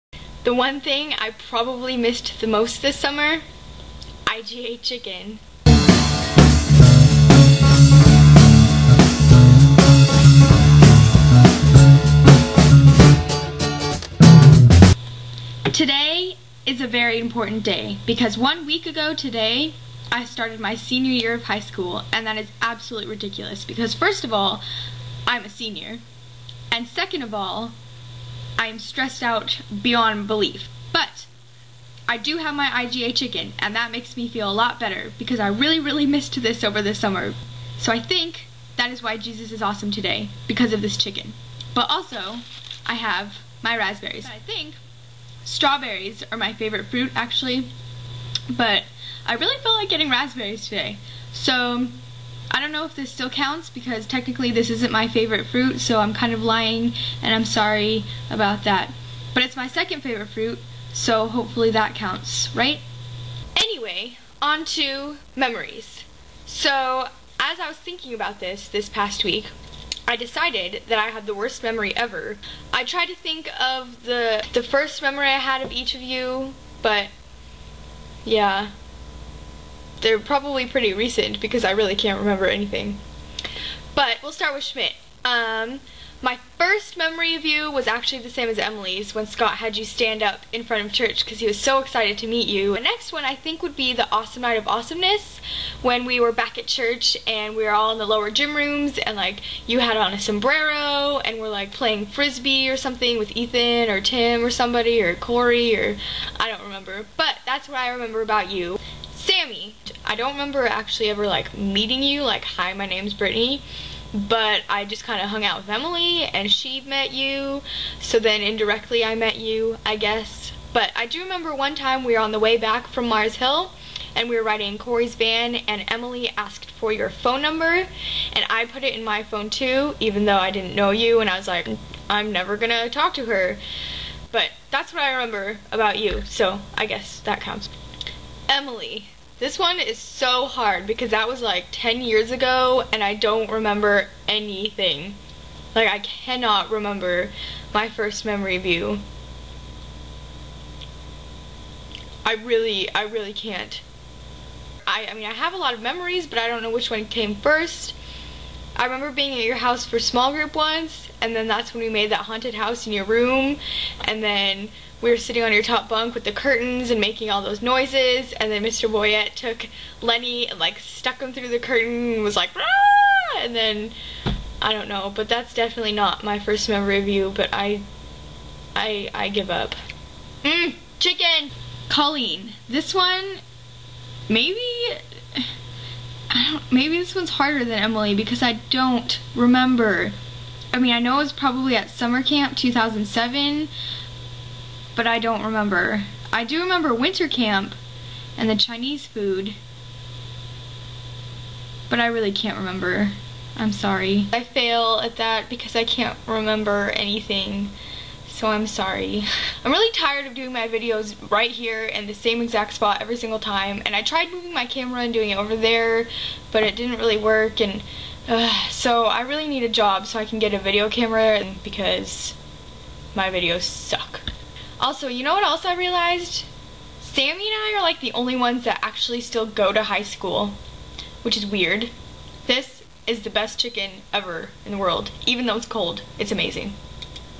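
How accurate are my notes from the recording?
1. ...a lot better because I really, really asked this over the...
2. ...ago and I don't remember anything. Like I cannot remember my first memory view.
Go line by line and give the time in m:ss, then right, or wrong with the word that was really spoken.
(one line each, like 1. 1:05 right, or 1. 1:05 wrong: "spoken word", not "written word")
1. 0:34 wrong: "missed", not "asked"
2. 2:22 right.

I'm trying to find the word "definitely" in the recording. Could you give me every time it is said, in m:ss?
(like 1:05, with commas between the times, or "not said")
2:55.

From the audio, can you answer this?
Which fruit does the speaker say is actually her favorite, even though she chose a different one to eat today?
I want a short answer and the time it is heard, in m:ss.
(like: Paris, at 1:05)
Strawberries, at 0:45.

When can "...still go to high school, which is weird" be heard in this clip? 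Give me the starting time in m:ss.
3:49.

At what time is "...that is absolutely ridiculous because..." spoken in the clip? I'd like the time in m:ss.
0:22.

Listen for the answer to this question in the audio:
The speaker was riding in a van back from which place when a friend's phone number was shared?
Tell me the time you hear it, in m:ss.
2:03.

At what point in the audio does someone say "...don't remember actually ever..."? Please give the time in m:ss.
1:50.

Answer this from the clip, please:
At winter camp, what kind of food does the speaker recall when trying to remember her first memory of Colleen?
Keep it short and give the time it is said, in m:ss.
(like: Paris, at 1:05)
Chinese food, at 3:18.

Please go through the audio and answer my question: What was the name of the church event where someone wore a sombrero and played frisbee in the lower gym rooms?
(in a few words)
Awesome Night of Awesomeness.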